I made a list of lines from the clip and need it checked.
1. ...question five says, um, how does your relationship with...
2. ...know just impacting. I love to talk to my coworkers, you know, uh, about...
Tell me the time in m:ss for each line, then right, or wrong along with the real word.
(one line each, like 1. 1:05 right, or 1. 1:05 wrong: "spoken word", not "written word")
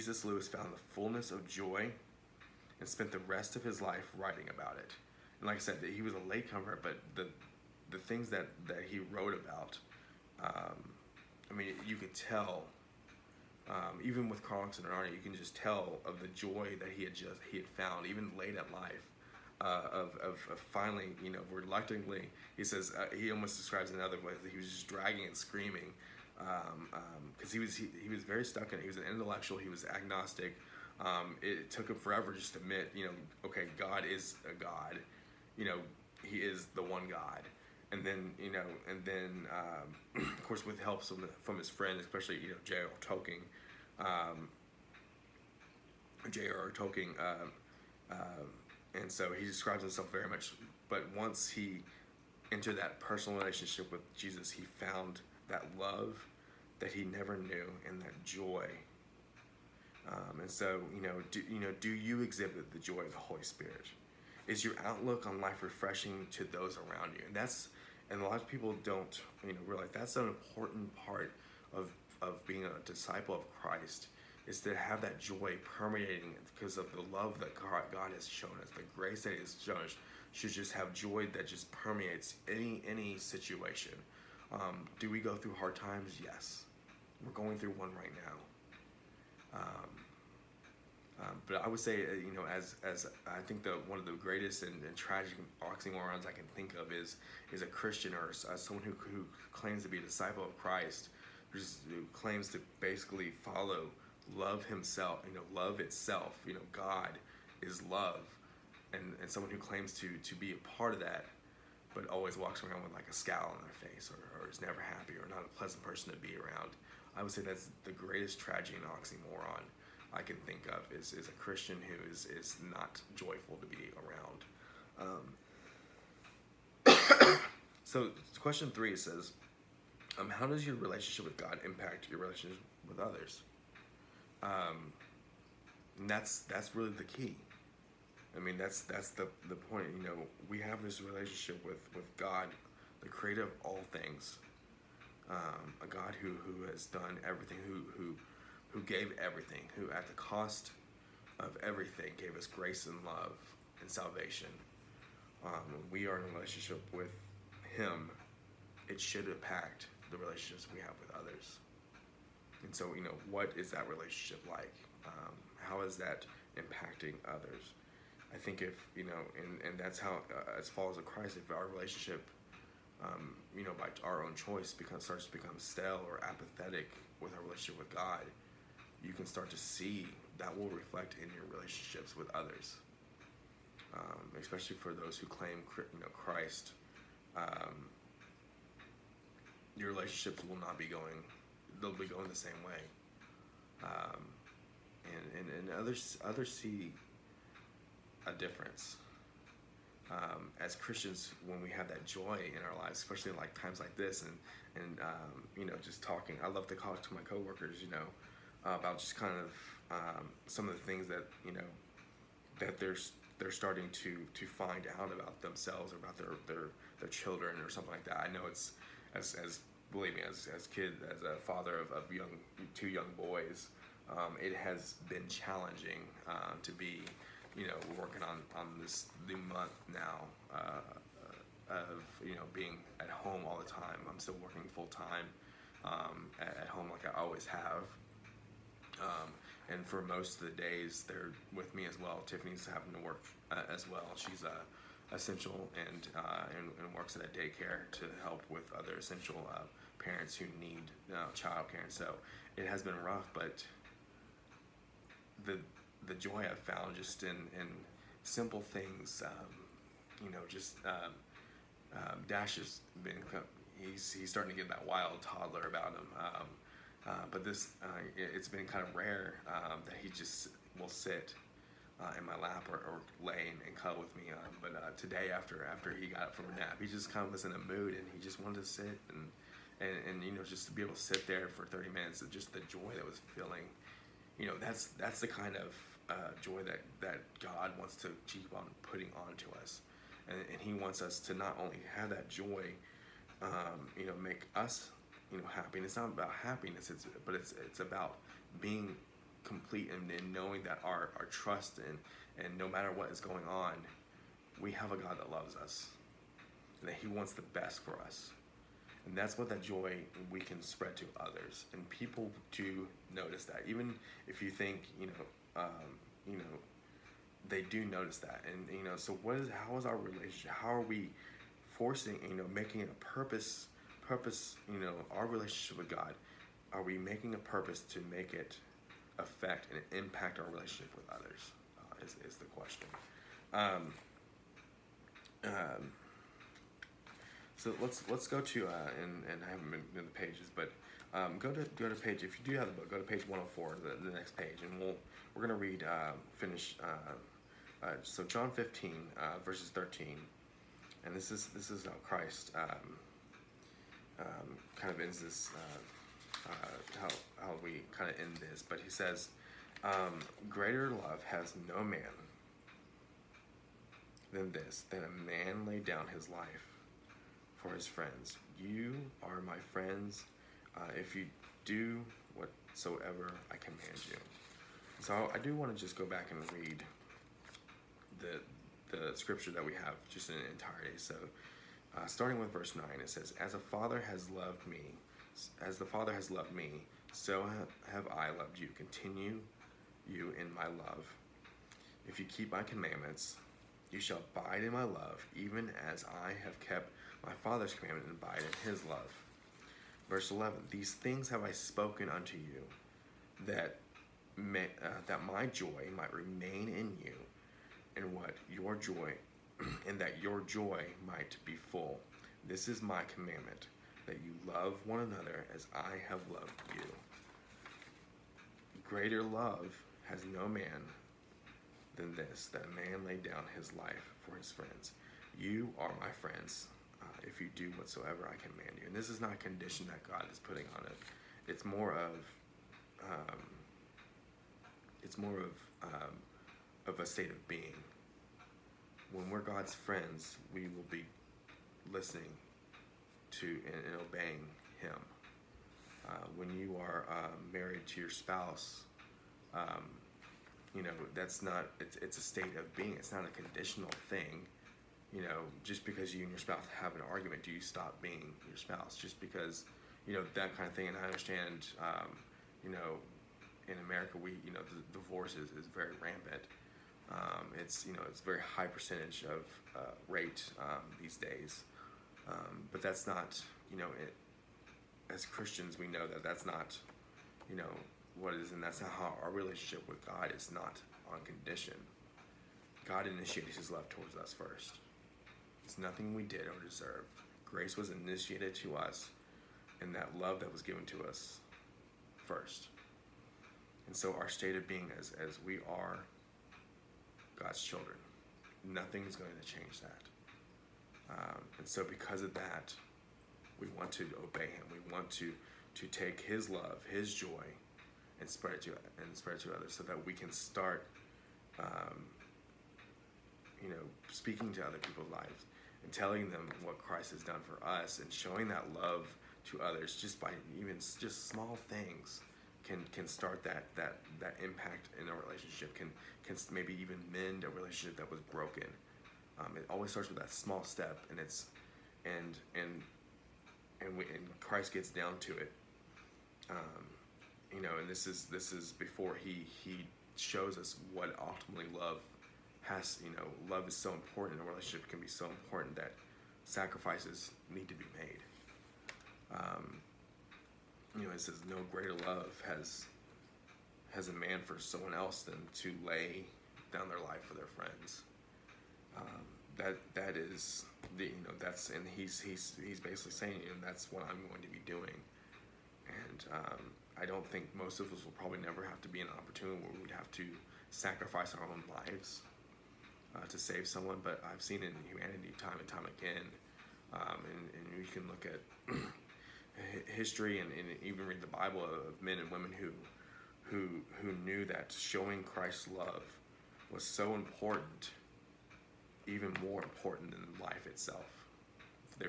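1. 2:08 wrong: "three", not "five"
2. 3:25 wrong: "talking", not "impacting".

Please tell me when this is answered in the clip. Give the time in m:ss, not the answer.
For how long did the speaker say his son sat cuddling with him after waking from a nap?
4:41.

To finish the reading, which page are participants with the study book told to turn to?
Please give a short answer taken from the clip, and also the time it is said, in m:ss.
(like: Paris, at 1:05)
104, at 5:43.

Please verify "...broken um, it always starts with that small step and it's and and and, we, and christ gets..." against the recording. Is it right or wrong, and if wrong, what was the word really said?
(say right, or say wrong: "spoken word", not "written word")
right.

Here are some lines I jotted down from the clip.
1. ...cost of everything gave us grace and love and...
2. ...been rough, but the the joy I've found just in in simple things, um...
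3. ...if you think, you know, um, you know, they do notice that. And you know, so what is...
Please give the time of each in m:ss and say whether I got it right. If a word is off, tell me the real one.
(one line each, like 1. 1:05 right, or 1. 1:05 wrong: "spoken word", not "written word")
1. 2:30 right
2. 4:12 right
3. 5:14 right.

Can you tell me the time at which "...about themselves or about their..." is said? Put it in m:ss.
3:35.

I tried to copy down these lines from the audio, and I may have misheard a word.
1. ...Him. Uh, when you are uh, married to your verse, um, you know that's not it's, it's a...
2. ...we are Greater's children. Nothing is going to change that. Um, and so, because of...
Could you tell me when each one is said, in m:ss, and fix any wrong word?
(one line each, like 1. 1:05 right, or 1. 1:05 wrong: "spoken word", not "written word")
1. 7:24 wrong: "spouse", not "verse"
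2. 8:15 wrong: "God", not "Greater".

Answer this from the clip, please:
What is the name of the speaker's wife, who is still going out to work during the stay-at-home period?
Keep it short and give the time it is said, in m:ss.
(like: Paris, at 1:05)
Tiffany, at 4:02.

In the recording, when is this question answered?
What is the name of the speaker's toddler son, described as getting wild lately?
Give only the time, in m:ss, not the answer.
4:22.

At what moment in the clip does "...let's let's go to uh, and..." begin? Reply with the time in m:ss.
5:37.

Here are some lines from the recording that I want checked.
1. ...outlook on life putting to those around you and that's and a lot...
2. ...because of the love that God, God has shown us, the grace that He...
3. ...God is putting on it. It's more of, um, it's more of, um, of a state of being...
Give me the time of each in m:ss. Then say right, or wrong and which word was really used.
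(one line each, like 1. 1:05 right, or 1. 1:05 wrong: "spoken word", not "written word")
1. 1:04 wrong: "refreshing", not "putting"
2. 1:16 right
3. 7:10 right.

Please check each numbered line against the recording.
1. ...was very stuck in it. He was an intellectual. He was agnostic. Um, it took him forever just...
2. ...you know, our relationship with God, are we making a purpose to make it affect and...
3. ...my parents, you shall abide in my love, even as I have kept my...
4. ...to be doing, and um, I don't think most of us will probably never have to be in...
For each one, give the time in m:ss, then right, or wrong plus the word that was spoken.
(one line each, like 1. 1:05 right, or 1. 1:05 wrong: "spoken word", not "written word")
1. 0:28 right
2. 5:24 right
3. 6:32 wrong: "commandments", not "parents"
4. 9:24 right.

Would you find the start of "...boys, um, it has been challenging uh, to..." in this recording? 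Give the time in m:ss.
3:43.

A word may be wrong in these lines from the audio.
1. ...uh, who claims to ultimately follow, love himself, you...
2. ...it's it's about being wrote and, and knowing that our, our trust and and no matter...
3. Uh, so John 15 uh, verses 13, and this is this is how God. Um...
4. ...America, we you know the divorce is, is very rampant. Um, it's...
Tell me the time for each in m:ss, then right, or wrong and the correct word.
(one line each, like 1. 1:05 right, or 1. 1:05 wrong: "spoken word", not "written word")
1. 1:41 wrong: "basically", not "ultimately"
2. 4:57 wrong: "complete", not "wrote"
3. 5:46 wrong: "Christ", not "God"
4. 7:43 right.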